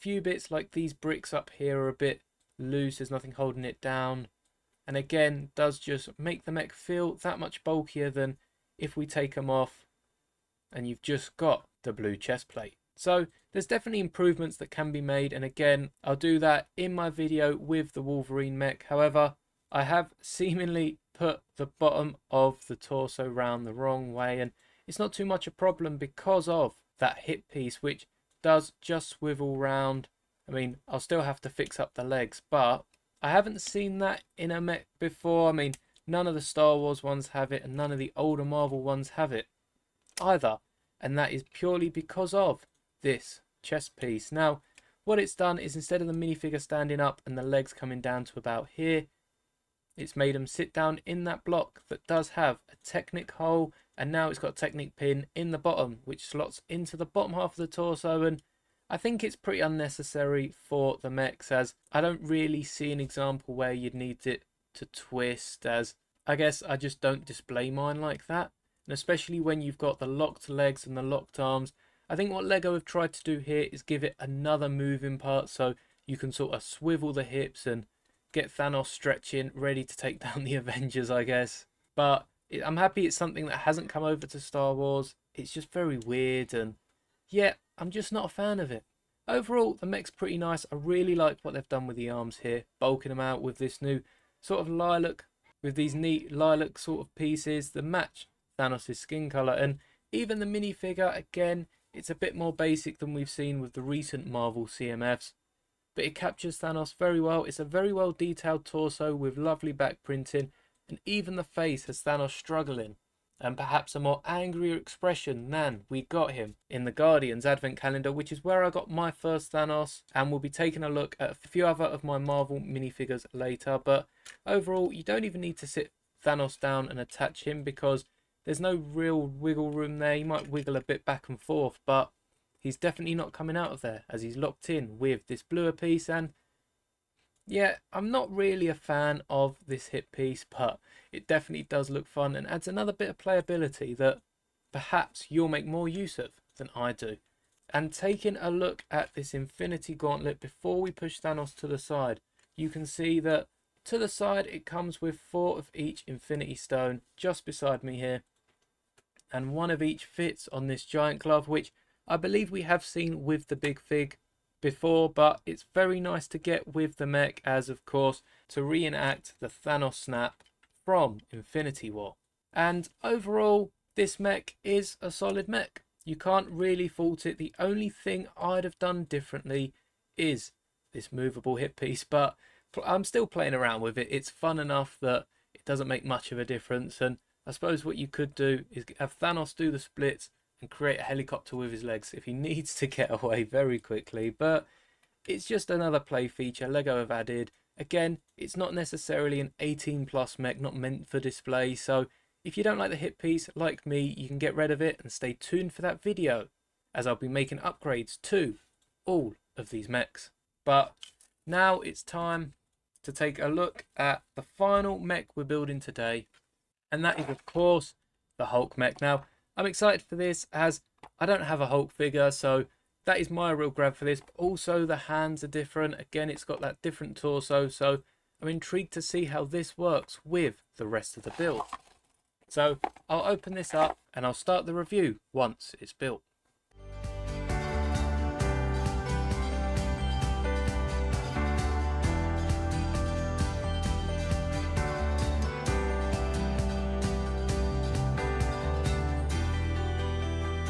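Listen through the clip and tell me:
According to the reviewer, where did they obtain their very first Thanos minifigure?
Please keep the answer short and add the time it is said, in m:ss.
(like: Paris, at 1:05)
Guardians advent calendar, at 1:56.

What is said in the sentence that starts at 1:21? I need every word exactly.
But I'm happy it's something that hasn't come over to Star Wars.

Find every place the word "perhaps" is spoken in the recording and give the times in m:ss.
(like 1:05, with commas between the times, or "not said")
1:53, 2:24.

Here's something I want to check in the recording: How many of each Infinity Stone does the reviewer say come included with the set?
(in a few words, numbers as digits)
4.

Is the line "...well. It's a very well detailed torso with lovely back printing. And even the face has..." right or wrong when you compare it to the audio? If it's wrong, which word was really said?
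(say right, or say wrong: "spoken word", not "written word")
right.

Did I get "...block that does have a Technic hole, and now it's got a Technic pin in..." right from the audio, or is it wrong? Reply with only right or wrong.
right.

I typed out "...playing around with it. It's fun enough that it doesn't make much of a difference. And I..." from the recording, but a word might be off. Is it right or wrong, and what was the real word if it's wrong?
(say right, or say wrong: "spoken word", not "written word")
right.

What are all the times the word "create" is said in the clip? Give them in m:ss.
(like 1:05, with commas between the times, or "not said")
3:10.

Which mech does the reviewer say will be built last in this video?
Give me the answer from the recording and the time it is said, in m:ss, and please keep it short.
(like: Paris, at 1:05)
Hulk mech, at 3:38.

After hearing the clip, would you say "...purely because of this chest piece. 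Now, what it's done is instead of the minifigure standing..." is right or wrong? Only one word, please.
right.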